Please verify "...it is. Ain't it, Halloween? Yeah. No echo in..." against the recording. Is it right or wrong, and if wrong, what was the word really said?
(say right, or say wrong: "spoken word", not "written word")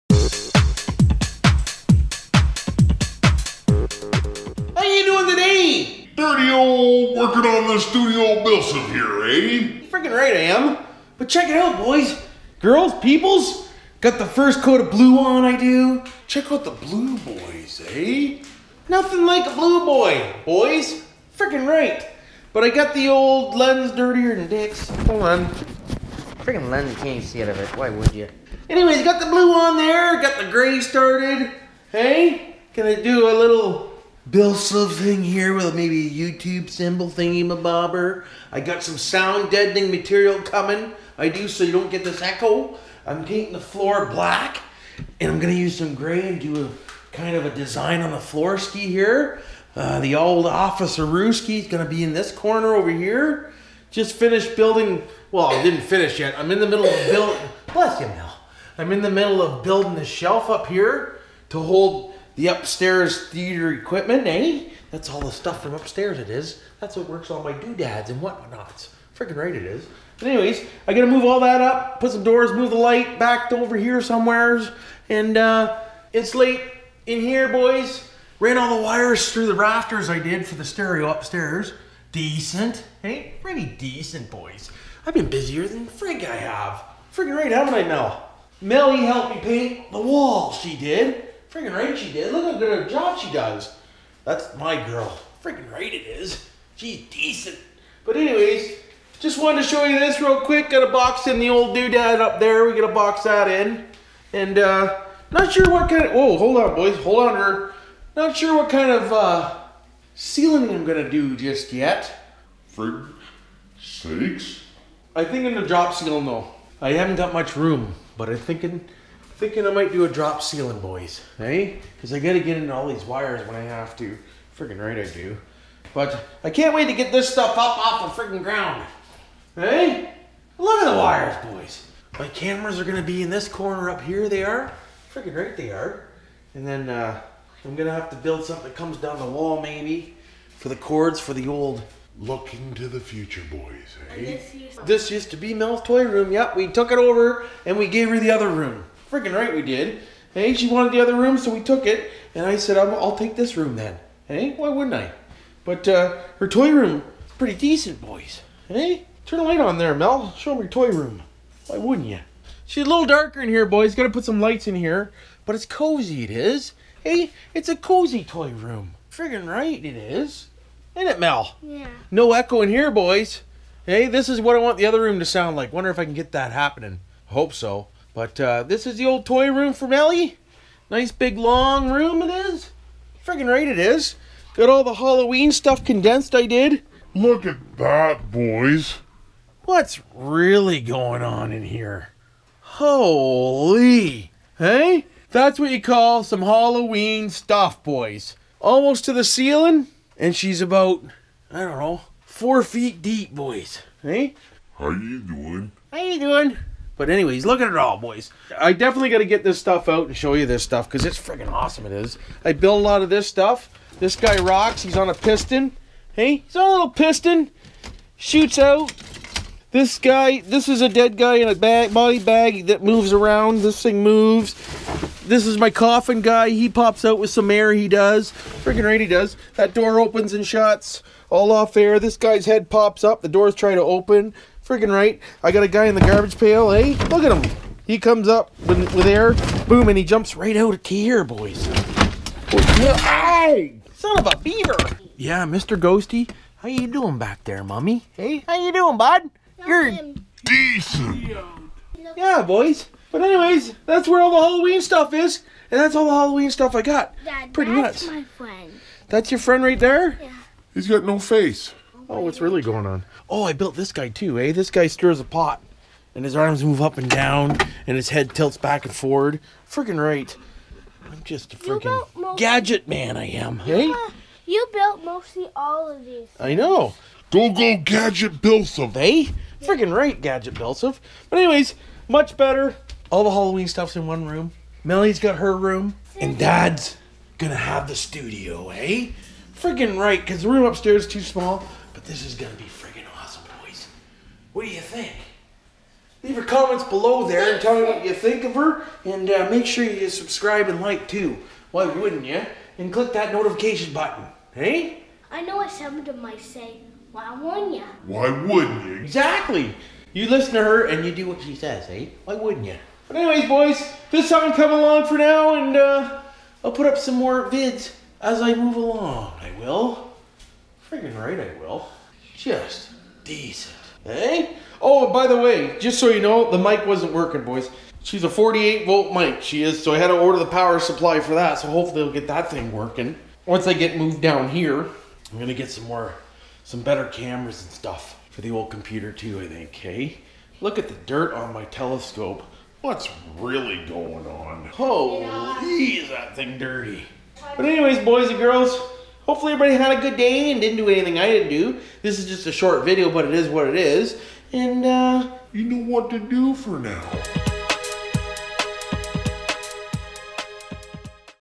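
wrong: "Mel", not "Halloween".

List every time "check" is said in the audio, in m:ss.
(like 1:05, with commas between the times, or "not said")
0:11, 0:16.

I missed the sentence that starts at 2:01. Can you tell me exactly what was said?
Because I gotta get into all these wires when I have to.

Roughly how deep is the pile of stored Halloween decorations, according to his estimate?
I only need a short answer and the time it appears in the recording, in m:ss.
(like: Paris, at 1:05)
4 feet, at 3:22.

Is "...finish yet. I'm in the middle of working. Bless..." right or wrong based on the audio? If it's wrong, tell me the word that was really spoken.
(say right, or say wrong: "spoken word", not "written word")
wrong: "building", not "working".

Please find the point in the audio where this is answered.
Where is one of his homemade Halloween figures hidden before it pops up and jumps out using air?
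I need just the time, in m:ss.
3:55.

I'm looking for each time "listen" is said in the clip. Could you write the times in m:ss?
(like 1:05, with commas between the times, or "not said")
5:10.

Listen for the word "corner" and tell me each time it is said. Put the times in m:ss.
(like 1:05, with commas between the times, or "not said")
0:52, 2:13.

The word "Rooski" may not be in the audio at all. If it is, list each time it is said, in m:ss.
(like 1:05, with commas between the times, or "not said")
0:51.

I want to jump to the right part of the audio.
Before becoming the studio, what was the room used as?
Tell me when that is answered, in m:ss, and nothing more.
2:25.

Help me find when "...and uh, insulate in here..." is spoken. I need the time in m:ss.
1:15.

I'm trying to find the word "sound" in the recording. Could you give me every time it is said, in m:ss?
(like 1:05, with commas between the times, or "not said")
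0:38, 2:55.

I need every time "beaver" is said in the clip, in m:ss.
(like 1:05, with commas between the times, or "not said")
4:04.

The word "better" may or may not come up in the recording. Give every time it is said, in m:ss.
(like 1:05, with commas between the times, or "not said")
4:42, 5:36.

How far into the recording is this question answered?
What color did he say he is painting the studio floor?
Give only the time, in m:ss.
0:44.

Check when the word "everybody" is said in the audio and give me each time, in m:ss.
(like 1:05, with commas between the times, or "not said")
5:49.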